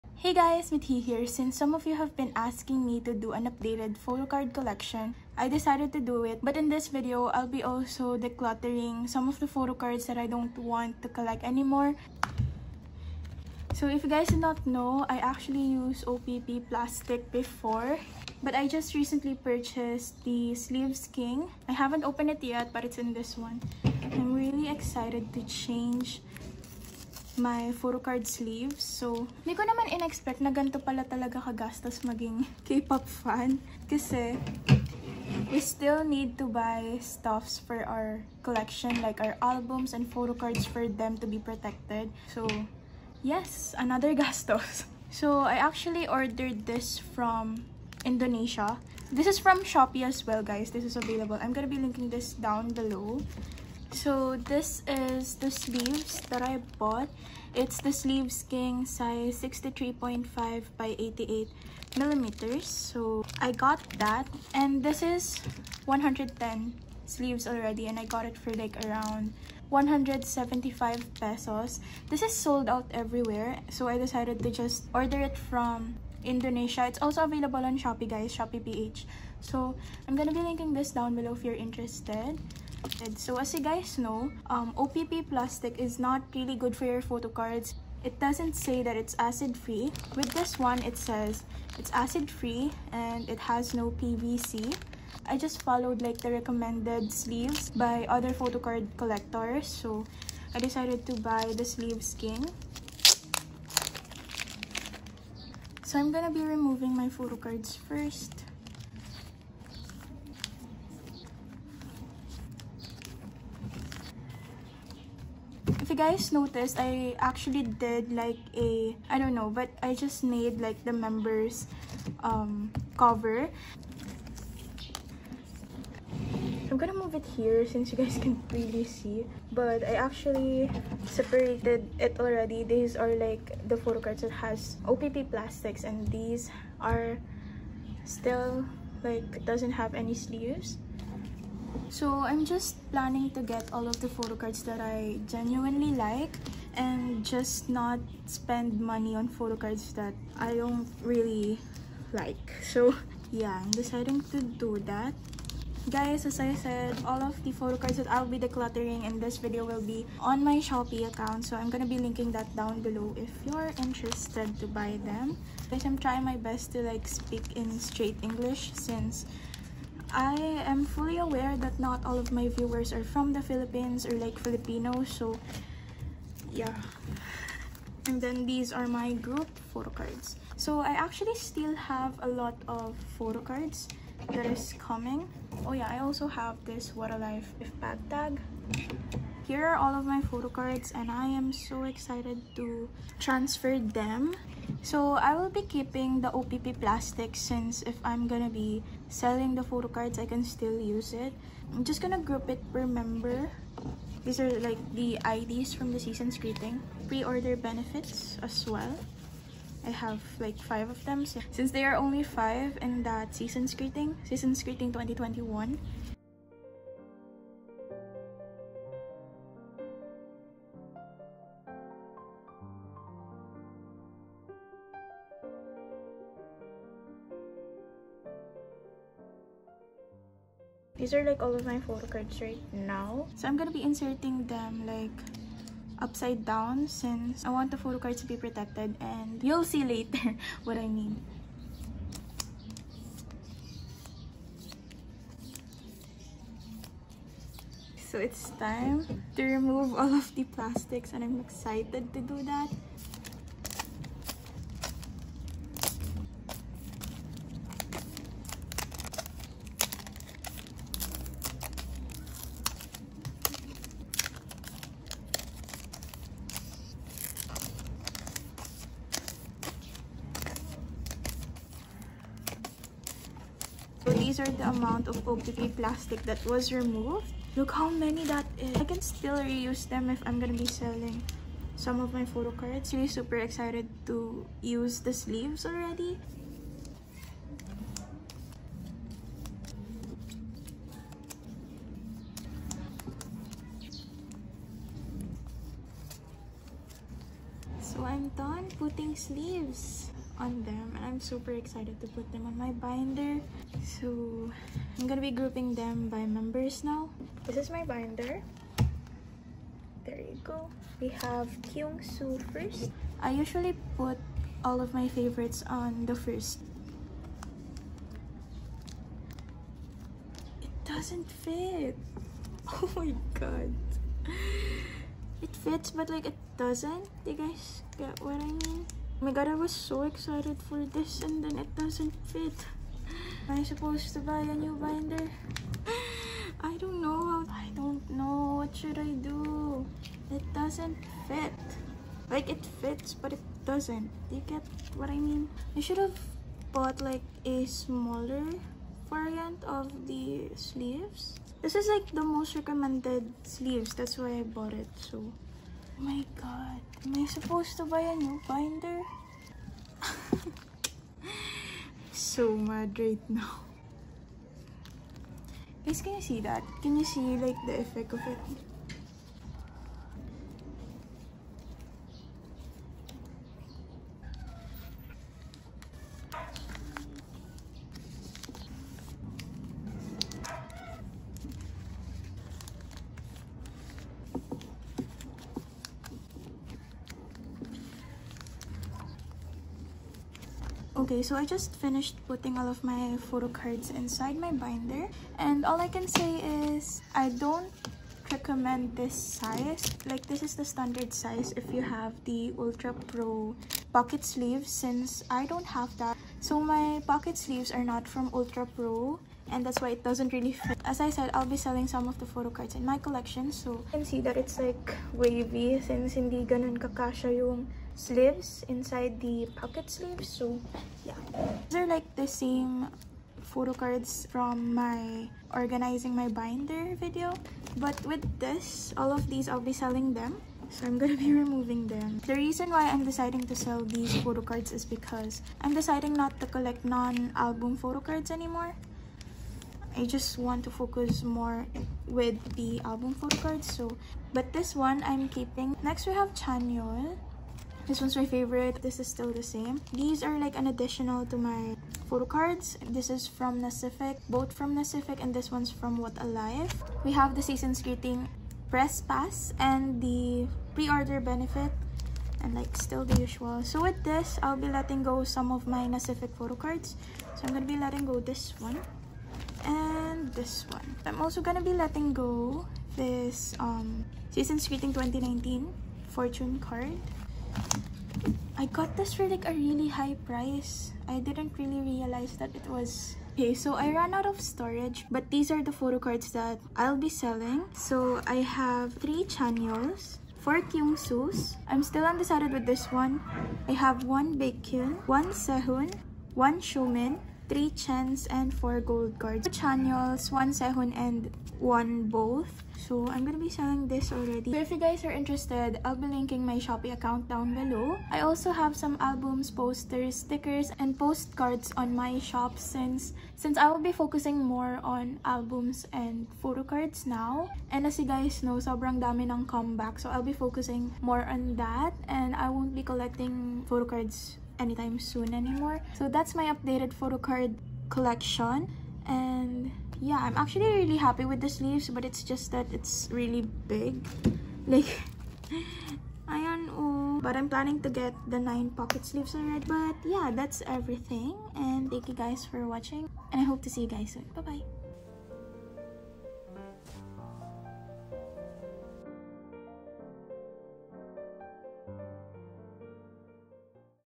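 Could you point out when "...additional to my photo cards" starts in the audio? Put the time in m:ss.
7:30.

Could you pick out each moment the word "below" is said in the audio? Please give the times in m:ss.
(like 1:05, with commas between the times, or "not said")
0:52, 1:21, 2:42, 8:27.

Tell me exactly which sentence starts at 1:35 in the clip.
I just followed like the recommended sleeves by other photo card collectors.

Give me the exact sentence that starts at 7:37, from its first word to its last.
We have the season's greeting press pass and the pre-order benefit and like still the usual.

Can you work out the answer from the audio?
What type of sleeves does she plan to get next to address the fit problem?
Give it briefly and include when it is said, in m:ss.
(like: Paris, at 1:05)
9 pocket sleeves, at 8:58.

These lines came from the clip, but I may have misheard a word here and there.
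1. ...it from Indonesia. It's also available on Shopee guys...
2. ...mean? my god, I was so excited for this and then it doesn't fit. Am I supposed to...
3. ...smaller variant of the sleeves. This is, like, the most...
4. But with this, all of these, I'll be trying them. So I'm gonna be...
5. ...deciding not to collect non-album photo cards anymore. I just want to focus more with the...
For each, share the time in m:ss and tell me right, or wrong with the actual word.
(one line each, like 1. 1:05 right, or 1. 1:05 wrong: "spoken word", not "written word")
1. 1:15 right
2. 5:28 right
3. 5:47 right
4. 7:07 wrong: "selling", not "trying"
5. 7:15 right.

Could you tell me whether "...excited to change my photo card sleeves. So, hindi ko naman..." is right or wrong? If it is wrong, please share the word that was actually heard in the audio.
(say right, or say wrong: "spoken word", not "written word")
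right.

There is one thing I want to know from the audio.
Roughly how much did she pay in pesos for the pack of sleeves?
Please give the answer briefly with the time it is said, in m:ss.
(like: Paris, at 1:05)
175 pesos, at 1:09.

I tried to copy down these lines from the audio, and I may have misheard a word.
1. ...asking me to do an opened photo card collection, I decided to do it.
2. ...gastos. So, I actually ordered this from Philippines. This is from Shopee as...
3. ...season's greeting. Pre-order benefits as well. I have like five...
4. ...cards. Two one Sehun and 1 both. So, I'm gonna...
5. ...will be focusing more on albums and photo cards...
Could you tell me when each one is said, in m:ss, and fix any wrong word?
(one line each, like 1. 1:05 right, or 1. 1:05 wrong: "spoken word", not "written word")
1. 0:02 wrong: "updated", not "opened"
2. 0:44 wrong: "Indonesia", not "Philippines"
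3. 3:25 right
4. 8:19 right
5. 8:33 right.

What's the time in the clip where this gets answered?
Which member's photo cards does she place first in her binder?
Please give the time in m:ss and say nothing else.
5:11.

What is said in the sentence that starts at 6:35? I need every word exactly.
And all I can say is I don't recommend this size.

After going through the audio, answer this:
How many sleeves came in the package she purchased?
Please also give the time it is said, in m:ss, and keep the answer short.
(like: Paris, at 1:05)
110, at 1:05.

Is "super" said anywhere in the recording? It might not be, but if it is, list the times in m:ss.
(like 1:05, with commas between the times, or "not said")
4:43, 5:01.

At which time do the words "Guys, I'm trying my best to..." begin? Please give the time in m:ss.
2:45.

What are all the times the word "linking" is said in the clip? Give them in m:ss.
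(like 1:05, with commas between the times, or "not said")
0:51, 1:20, 2:41, 8:26.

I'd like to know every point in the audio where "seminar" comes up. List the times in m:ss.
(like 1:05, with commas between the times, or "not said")
not said.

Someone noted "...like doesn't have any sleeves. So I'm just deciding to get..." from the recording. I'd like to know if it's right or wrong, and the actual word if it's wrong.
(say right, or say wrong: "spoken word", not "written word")
wrong: "planning", not "deciding".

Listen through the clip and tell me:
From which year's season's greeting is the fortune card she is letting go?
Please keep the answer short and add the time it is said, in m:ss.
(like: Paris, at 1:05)
2019, at 7:54.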